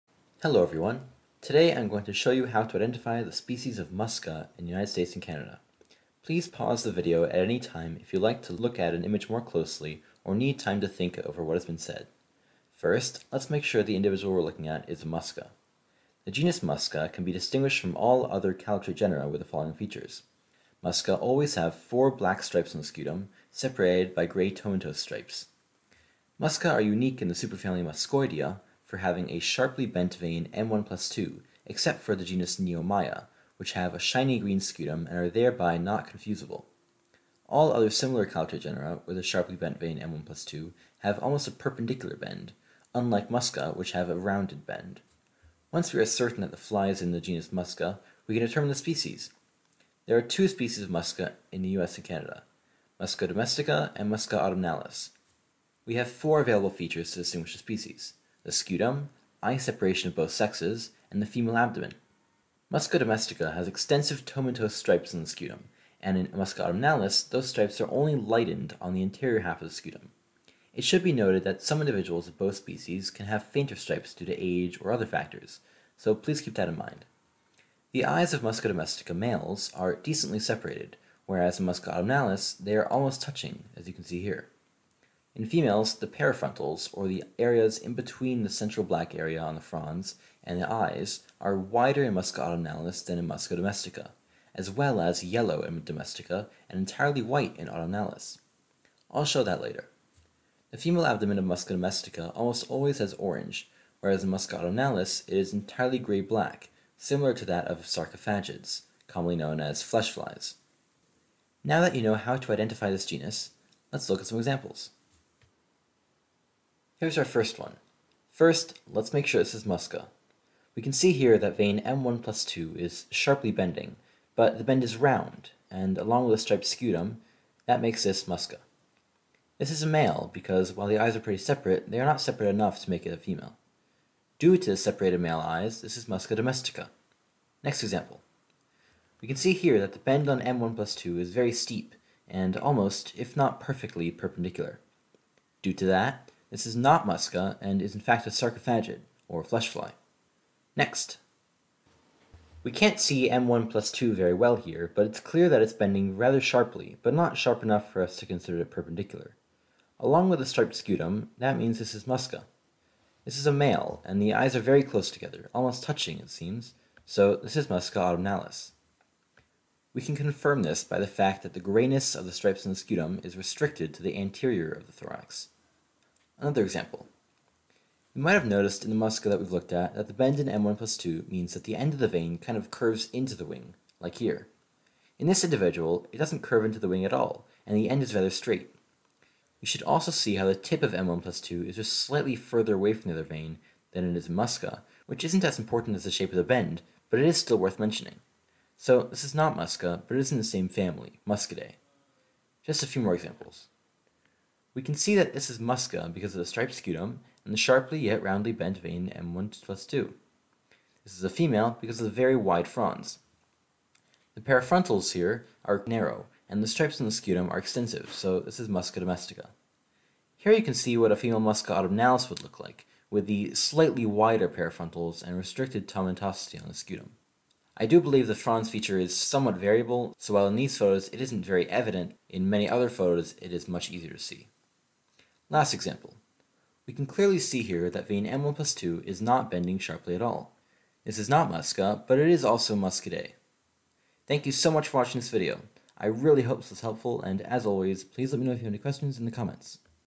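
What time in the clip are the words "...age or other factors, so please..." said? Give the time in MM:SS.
01:14.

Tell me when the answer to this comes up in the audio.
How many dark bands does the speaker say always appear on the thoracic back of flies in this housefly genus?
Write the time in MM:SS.
00:21.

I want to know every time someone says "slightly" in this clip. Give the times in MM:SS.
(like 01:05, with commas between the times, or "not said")
03:11, 03:43.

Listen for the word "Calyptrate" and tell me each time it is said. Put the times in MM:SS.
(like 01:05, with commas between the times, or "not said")
00:18.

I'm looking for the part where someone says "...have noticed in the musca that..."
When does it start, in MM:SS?
02:58.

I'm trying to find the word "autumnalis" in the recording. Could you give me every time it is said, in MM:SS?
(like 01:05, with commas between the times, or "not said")
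00:54, 01:06, 01:21, 01:32, 01:37, 01:44, 02:47, 03:41.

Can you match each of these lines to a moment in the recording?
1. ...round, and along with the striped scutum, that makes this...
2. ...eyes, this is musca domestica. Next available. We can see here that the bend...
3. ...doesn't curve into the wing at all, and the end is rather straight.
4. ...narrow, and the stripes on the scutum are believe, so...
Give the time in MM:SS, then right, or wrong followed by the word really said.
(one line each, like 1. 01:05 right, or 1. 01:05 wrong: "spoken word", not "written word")
1. 02:04 right
2. 02:15 wrong: "example", not "available"
3. 03:06 right
4. 03:35 wrong: "extensive", not "believe".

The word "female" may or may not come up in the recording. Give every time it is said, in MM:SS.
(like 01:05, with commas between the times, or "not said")
01:01, 01:25, 01:40, 02:13, 03:31, 03:41.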